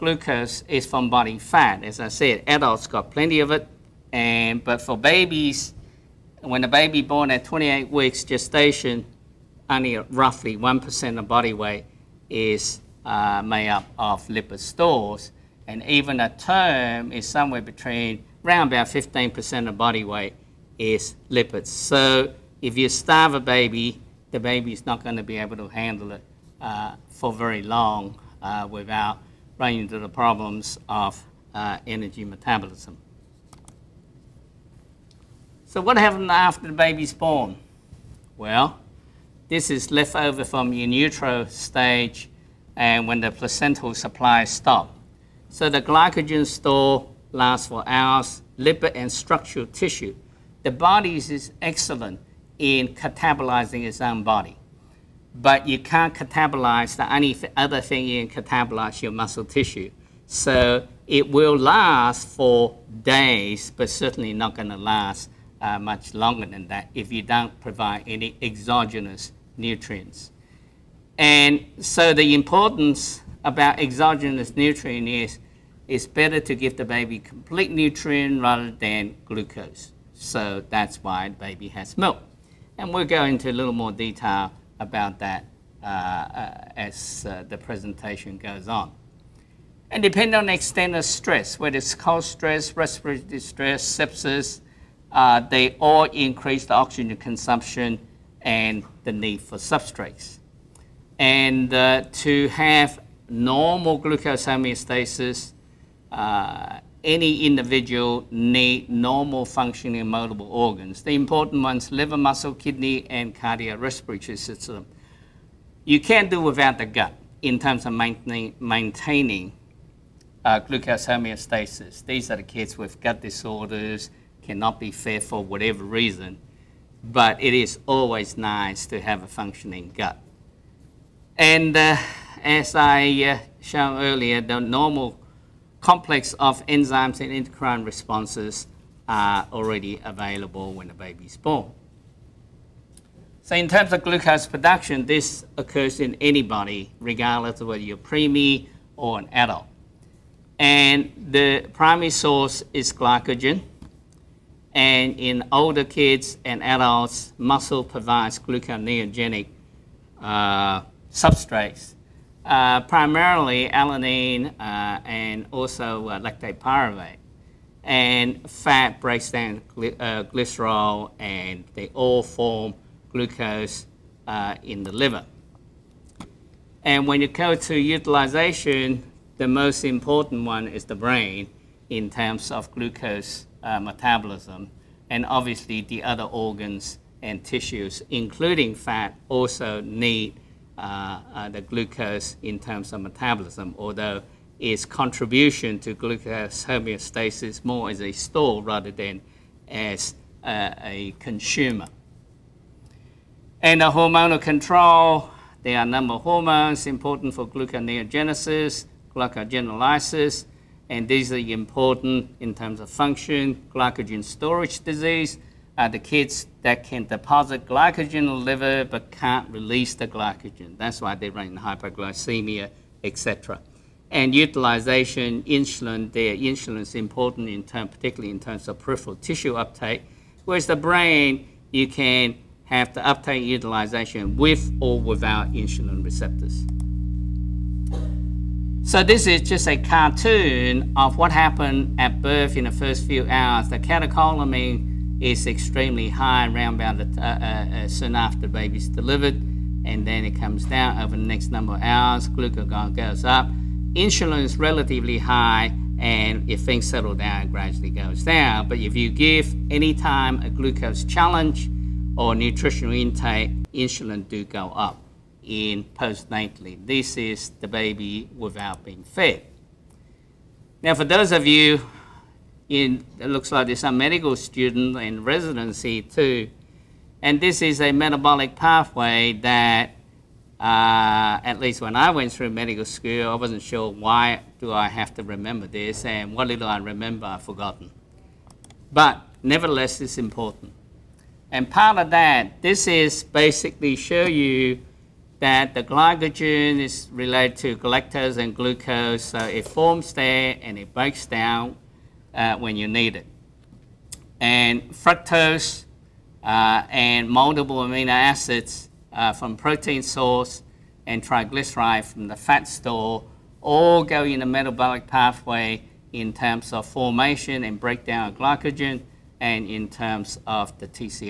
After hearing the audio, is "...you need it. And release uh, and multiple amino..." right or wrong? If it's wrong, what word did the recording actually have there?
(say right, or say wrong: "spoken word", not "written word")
wrong: "fructose", not "release".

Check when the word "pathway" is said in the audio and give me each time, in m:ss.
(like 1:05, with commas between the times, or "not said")
4:38, 5:15.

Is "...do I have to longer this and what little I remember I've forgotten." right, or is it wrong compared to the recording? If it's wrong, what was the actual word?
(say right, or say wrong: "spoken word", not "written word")
wrong: "remember", not "longer".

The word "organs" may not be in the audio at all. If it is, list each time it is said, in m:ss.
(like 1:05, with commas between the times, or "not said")
1:50, 3:06.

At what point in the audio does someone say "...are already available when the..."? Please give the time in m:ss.
2:19.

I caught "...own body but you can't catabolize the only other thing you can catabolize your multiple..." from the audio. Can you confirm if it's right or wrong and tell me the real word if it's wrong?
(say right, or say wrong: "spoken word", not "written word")
wrong: "muscle", not "multiple".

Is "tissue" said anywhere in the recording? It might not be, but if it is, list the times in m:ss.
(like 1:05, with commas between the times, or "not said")
0:49, 0:59, 3:07, 3:49.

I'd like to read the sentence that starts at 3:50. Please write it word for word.
Whereas the brain, you can have the uptake utilization with or without insulin receptors.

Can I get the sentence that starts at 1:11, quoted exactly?
And so the importance about exogenous nutrient is it's better to give the baby complete nutrient rather than glucose.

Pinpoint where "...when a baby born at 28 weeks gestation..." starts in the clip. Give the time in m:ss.
0:06.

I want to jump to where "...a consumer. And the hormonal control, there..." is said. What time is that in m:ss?
3:20.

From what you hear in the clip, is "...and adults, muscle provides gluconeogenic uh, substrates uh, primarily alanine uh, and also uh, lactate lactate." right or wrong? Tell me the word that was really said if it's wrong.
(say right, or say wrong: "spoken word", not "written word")
wrong: "pyruvate", not "lactate".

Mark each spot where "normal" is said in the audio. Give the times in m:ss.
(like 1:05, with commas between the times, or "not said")
1:43, 1:48, 2:14.